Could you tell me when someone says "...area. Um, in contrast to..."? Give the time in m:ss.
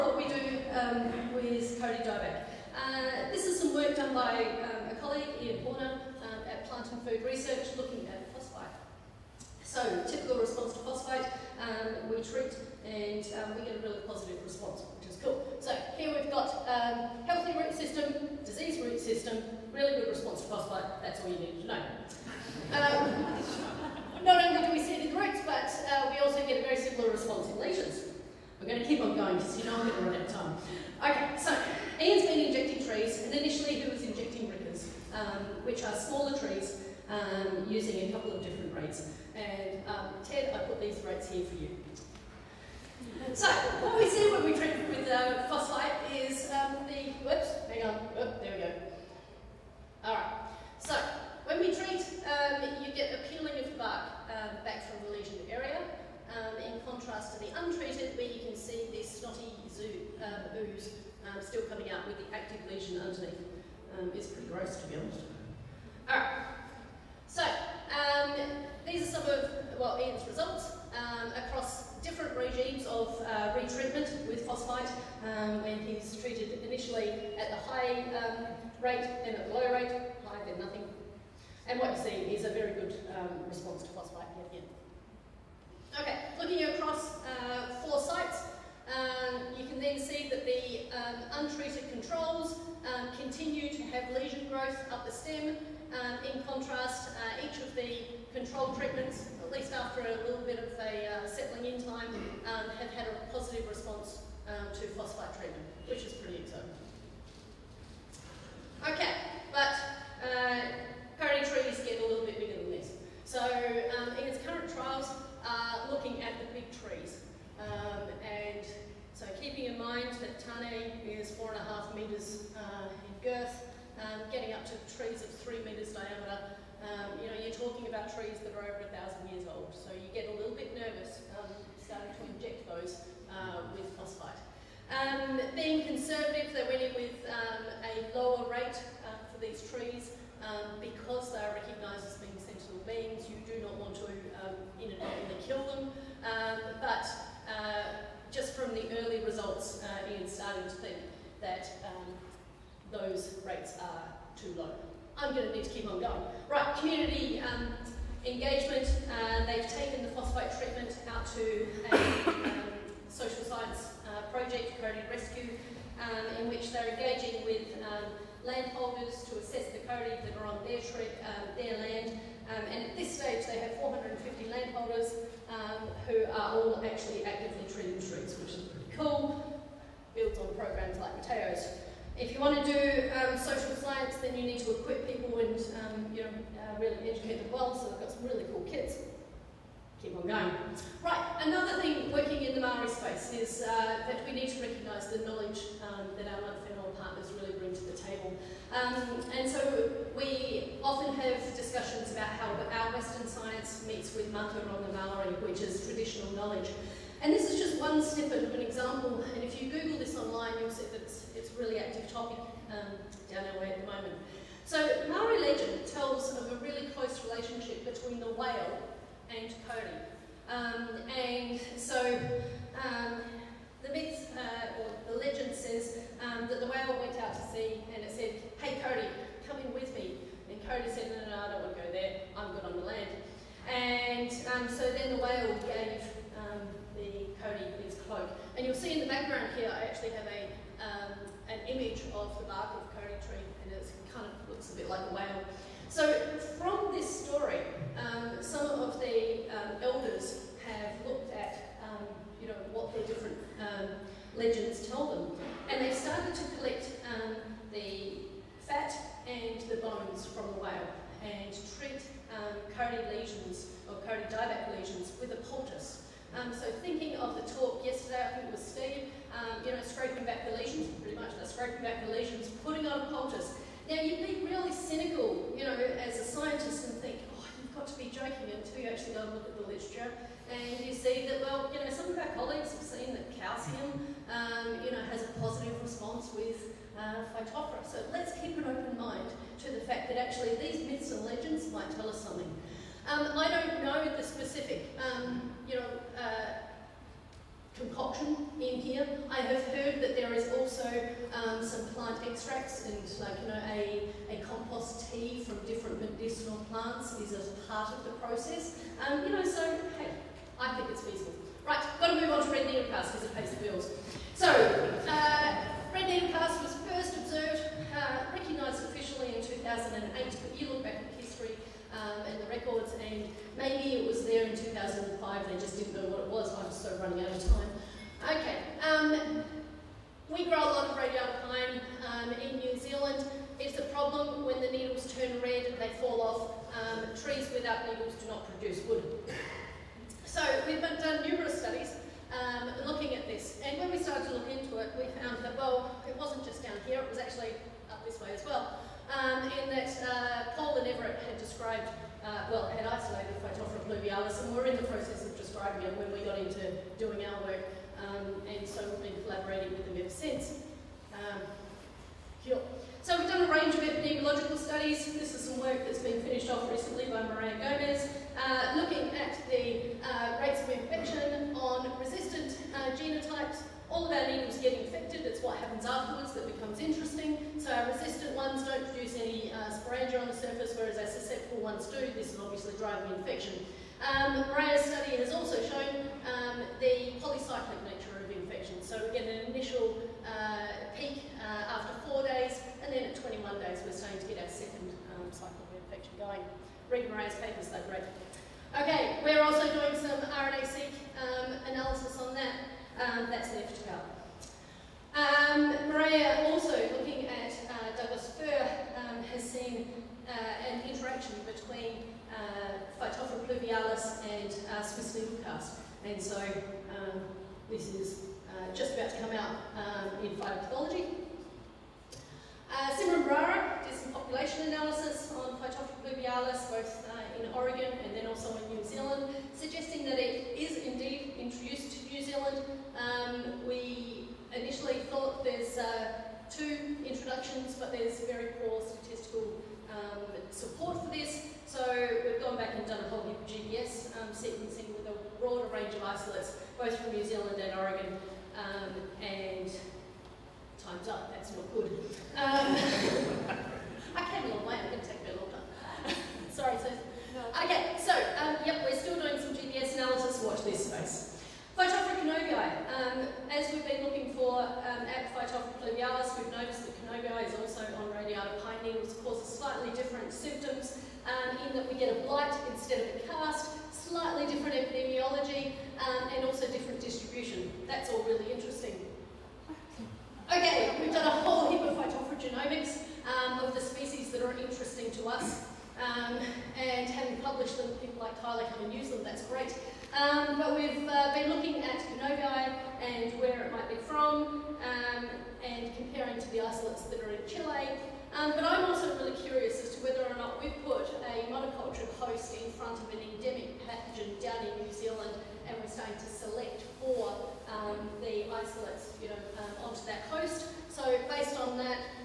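0:55.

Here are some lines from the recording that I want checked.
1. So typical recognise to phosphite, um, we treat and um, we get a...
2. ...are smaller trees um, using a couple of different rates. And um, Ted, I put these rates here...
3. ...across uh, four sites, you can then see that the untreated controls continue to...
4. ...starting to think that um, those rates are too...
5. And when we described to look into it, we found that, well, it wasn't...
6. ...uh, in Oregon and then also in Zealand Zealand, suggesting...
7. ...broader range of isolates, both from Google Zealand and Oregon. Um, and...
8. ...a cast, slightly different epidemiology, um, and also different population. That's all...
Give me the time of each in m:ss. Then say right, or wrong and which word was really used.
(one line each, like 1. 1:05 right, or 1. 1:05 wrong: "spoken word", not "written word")
1. 0:09 wrong: "response", not "recognise"
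2. 0:35 right
3. 1:26 right
4. 2:30 right
5. 5:43 wrong: "started", not "described"
6. 7:07 wrong: "New", not "Zealand"
7. 7:25 wrong: "New", not "Google"
8. 7:53 wrong: "distribution", not "population".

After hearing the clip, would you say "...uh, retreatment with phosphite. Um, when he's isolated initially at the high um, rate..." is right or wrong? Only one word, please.
wrong.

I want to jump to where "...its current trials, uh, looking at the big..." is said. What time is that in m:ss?
1:54.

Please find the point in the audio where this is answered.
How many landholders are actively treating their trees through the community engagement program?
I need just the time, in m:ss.
2:53.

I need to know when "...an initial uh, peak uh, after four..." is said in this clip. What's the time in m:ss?
6:29.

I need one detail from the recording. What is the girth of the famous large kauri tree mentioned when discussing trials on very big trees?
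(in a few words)
4.5 metres.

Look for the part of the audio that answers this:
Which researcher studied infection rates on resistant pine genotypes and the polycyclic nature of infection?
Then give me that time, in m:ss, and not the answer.
6:07.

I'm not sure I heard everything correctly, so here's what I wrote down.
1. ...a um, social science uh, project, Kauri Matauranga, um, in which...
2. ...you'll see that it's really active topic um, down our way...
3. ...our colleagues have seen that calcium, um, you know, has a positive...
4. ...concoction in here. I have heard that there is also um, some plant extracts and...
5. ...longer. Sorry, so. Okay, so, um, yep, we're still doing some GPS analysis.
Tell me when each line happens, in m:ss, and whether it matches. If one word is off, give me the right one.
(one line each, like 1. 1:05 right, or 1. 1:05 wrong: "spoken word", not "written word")
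1. 2:41 wrong: "Rescue", not "Matauranga"
2. 3:30 right
3. 4:42 right
4. 4:57 right
5. 7:35 right.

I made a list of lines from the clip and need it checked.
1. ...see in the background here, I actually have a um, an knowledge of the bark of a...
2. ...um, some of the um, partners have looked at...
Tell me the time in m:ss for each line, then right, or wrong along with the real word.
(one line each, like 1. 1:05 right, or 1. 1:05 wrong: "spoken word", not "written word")
1. 3:58 wrong: "image", not "knowledge"
2. 4:07 wrong: "elders", not "partners".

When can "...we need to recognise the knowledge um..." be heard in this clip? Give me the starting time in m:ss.
3:14.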